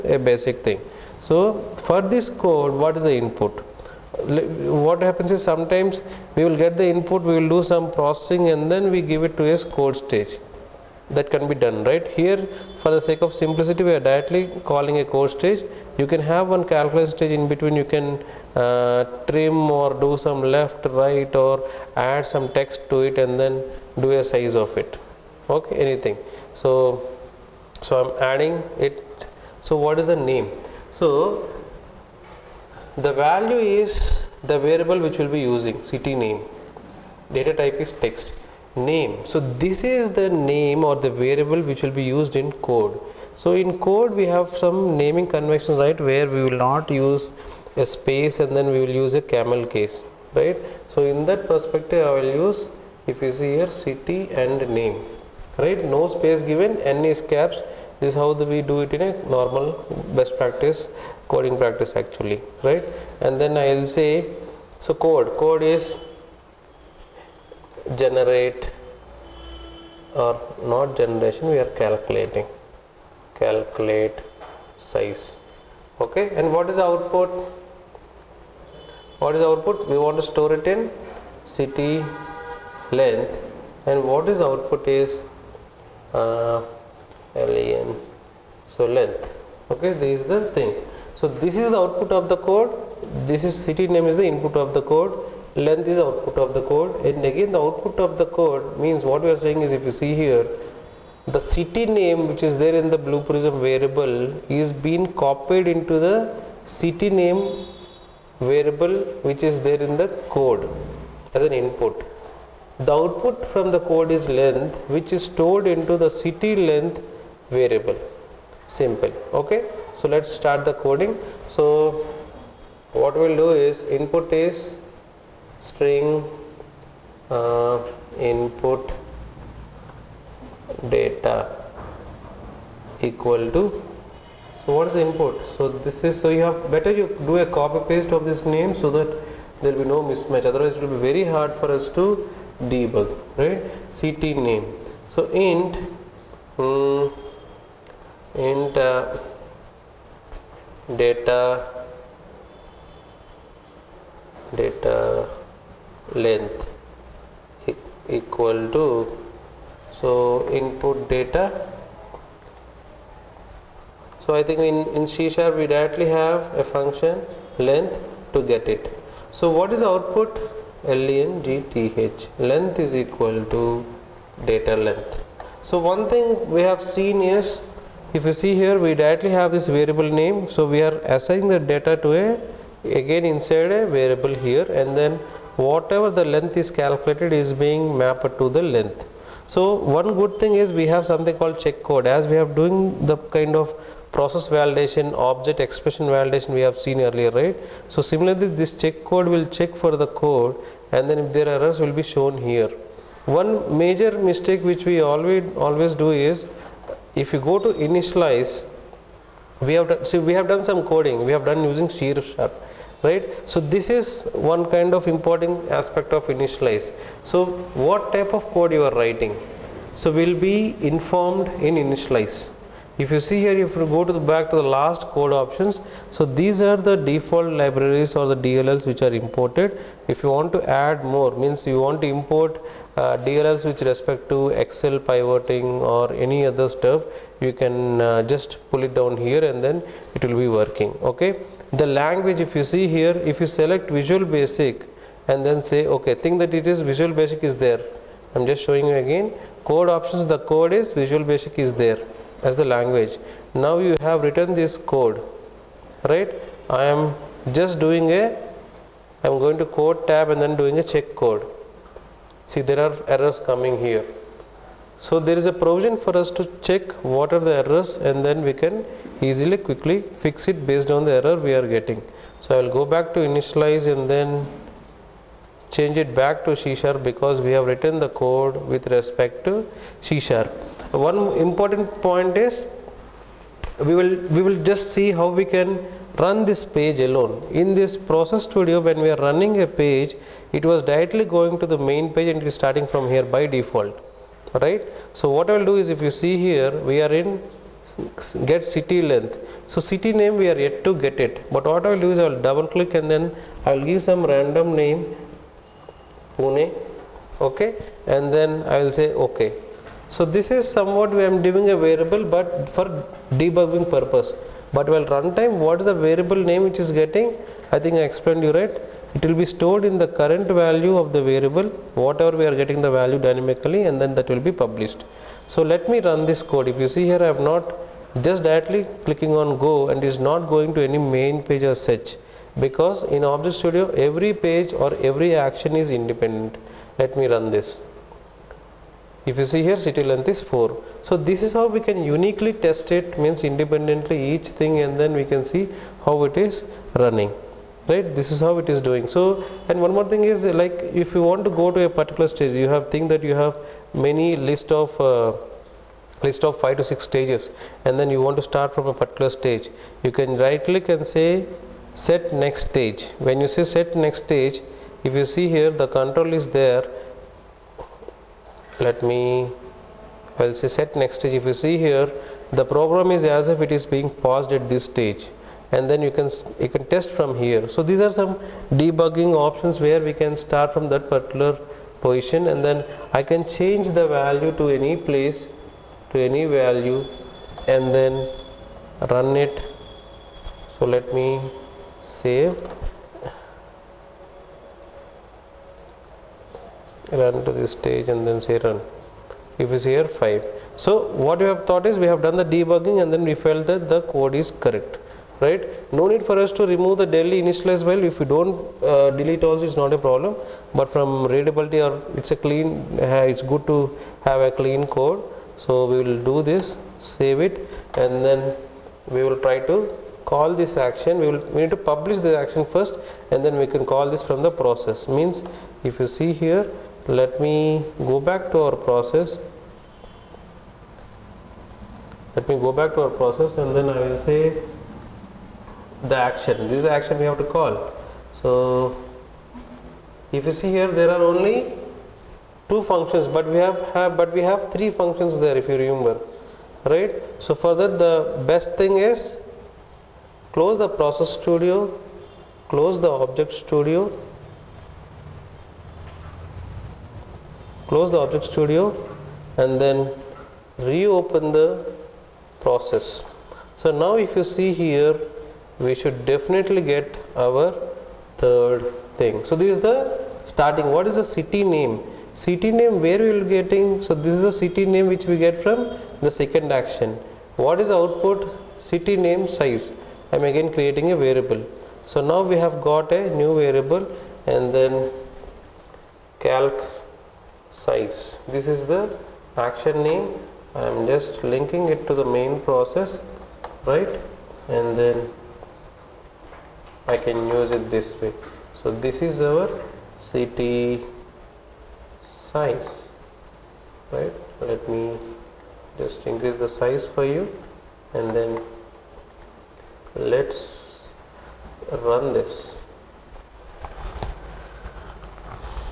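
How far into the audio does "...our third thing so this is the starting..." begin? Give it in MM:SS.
07:47.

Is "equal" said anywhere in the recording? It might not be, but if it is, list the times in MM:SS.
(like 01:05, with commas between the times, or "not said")
02:13, 02:38, 02:52.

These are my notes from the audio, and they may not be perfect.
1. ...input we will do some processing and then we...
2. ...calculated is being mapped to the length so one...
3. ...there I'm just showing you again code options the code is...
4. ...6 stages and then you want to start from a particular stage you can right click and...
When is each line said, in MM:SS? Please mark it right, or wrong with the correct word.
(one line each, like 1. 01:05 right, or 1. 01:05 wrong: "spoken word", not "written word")
1. 00:06 right
2. 03:06 right
3. 04:07 right
4. 05:56 right.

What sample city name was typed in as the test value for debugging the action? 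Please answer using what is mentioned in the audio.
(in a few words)
Pune.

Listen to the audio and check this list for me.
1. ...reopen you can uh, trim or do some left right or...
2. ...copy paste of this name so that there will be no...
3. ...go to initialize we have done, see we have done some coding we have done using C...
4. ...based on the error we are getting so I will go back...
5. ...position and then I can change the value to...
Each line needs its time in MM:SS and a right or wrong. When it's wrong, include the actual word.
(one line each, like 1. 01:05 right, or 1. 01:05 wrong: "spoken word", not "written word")
1. 00:17 wrong: "between", not "reopen"
2. 02:17 right
3. 03:27 right
4. 04:30 right
5. 06:22 right.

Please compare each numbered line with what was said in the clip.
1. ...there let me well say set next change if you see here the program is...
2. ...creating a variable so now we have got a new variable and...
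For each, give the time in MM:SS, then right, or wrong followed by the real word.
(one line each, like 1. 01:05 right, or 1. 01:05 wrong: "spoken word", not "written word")
1. 06:06 wrong: "stage", not "change"
2. 08:00 right.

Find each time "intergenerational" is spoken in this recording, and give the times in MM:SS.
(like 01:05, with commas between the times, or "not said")
not said.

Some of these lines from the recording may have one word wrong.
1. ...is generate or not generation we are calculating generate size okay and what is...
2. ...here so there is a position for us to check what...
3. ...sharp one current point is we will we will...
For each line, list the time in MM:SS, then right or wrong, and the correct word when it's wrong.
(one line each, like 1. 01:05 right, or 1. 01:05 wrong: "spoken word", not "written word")
1. 01:05 wrong: "calculate", not "generate"
2. 04:23 wrong: "provision", not "position"
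3. 04:40 wrong: "important", not "current".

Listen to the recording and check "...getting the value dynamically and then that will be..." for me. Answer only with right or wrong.
right.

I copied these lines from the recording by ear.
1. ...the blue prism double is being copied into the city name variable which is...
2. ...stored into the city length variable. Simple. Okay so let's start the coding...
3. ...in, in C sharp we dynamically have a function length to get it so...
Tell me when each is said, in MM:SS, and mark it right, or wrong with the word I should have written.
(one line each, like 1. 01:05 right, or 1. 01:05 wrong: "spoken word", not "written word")
1. 01:42 wrong: "variable", not "double"
2. 01:55 right
3. 02:44 wrong: "directly", not "dynamically".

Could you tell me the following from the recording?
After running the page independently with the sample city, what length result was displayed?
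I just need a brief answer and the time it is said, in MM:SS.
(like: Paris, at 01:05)
4, at 05:40.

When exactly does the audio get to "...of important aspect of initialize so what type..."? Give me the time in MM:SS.
03:34.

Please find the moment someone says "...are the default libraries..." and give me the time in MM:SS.
03:46.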